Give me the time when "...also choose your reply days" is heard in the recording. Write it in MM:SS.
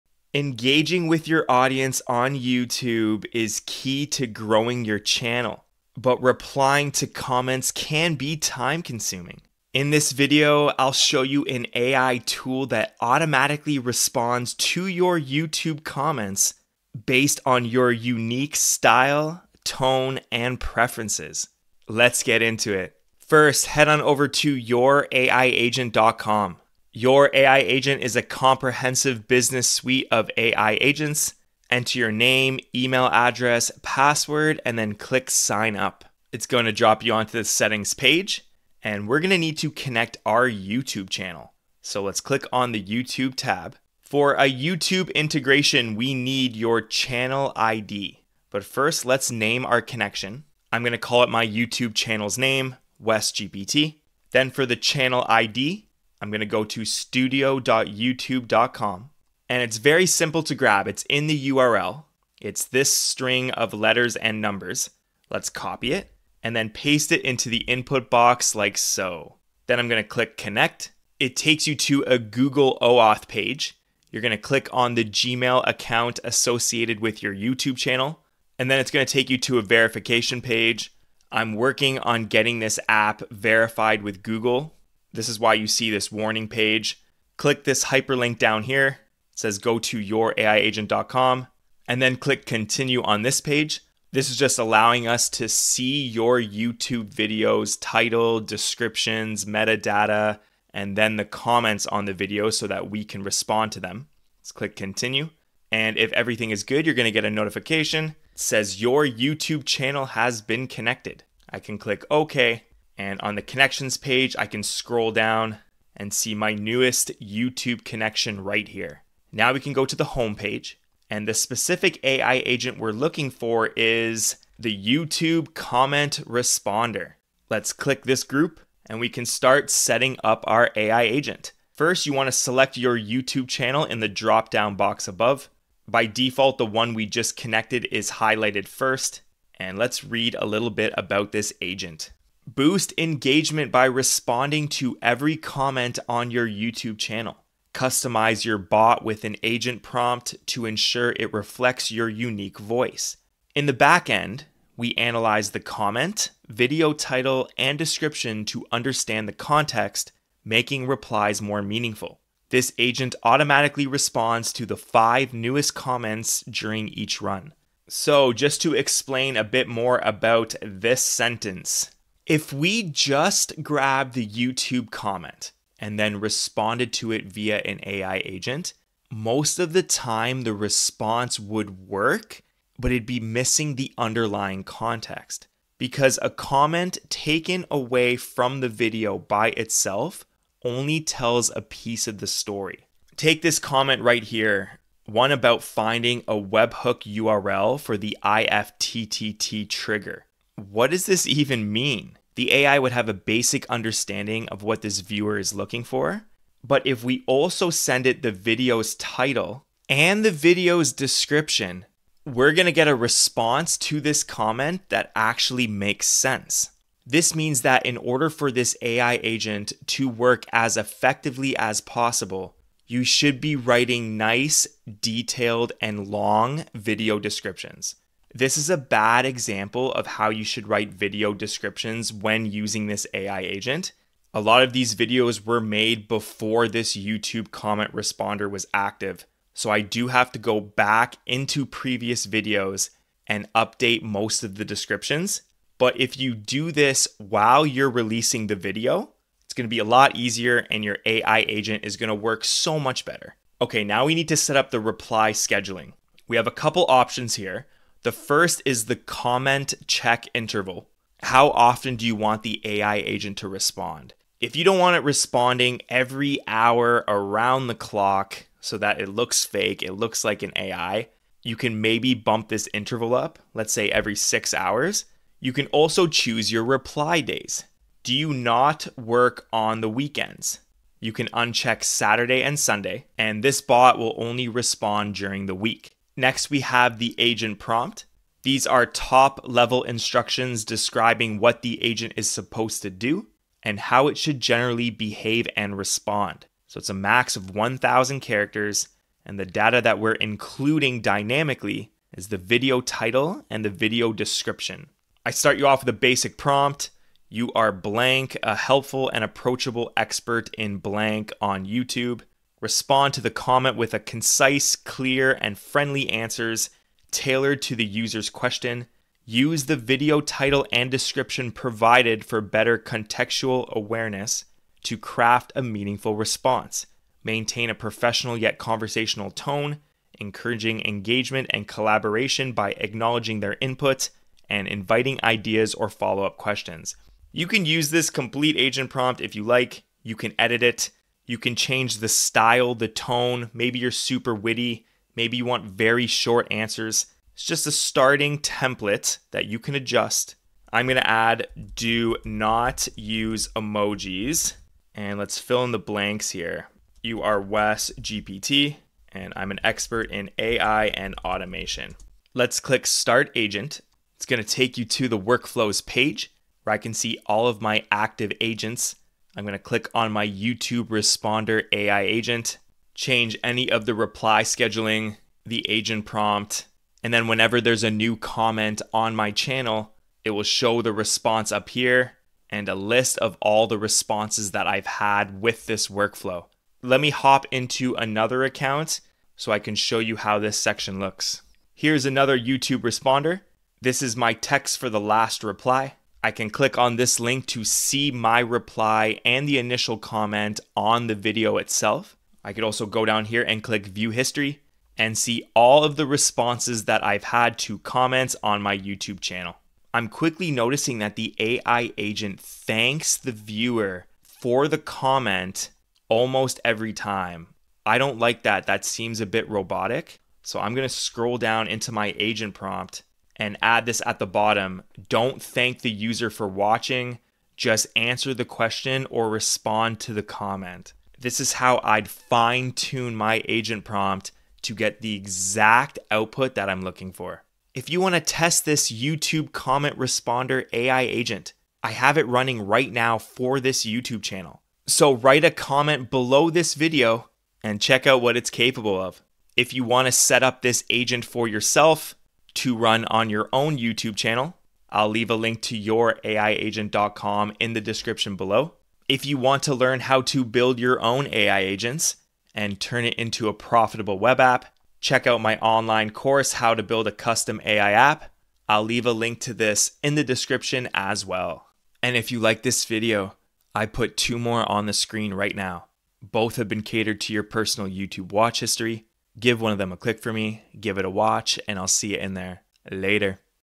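04:35.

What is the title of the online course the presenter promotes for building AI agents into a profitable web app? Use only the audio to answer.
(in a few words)
How to Build a Custom AI App.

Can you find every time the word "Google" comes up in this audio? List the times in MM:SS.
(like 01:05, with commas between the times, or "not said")
01:12, 01:24.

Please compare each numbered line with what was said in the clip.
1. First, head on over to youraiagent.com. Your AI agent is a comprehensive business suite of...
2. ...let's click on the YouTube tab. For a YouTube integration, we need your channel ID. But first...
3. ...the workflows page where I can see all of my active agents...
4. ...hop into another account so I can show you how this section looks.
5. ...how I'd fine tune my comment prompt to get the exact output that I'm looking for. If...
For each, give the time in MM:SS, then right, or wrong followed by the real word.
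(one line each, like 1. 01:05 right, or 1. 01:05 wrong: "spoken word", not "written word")
1. 00:23 right
2. 00:42 right
3. 06:05 right
4. 06:27 right
5. 07:11 wrong: "agent", not "comment".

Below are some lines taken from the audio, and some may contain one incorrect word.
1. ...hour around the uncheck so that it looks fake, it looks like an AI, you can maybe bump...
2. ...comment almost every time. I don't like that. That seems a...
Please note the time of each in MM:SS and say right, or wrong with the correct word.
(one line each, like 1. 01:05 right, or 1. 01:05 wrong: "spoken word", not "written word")
1. 04:26 wrong: "clock", not "uncheck"
2. 06:54 right.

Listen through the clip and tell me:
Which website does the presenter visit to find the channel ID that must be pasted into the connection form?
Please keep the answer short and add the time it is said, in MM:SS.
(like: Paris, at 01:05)
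studio.youtube.com, at 00:56.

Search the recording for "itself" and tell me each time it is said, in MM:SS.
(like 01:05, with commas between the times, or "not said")
03:09, 06:41.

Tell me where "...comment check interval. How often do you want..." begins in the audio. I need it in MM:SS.
04:18.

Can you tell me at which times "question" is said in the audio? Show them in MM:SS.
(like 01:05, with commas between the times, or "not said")
05:18, 05:36, 07:08.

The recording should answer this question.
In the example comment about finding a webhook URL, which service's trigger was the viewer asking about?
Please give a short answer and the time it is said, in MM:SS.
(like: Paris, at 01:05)
IFTTT, at 03:18.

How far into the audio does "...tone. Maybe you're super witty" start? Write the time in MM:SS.
05:42.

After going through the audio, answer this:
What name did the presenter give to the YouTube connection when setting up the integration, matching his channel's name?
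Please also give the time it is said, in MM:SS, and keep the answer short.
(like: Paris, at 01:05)
WesGPT, at 00:53.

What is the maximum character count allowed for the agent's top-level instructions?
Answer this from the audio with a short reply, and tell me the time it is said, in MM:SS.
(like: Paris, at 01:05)
1,000, at 04:57.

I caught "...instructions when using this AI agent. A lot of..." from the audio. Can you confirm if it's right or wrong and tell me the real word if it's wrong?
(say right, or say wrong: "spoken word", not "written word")
wrong: "descriptions", not "instructions".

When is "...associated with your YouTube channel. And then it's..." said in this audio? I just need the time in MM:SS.
01:16.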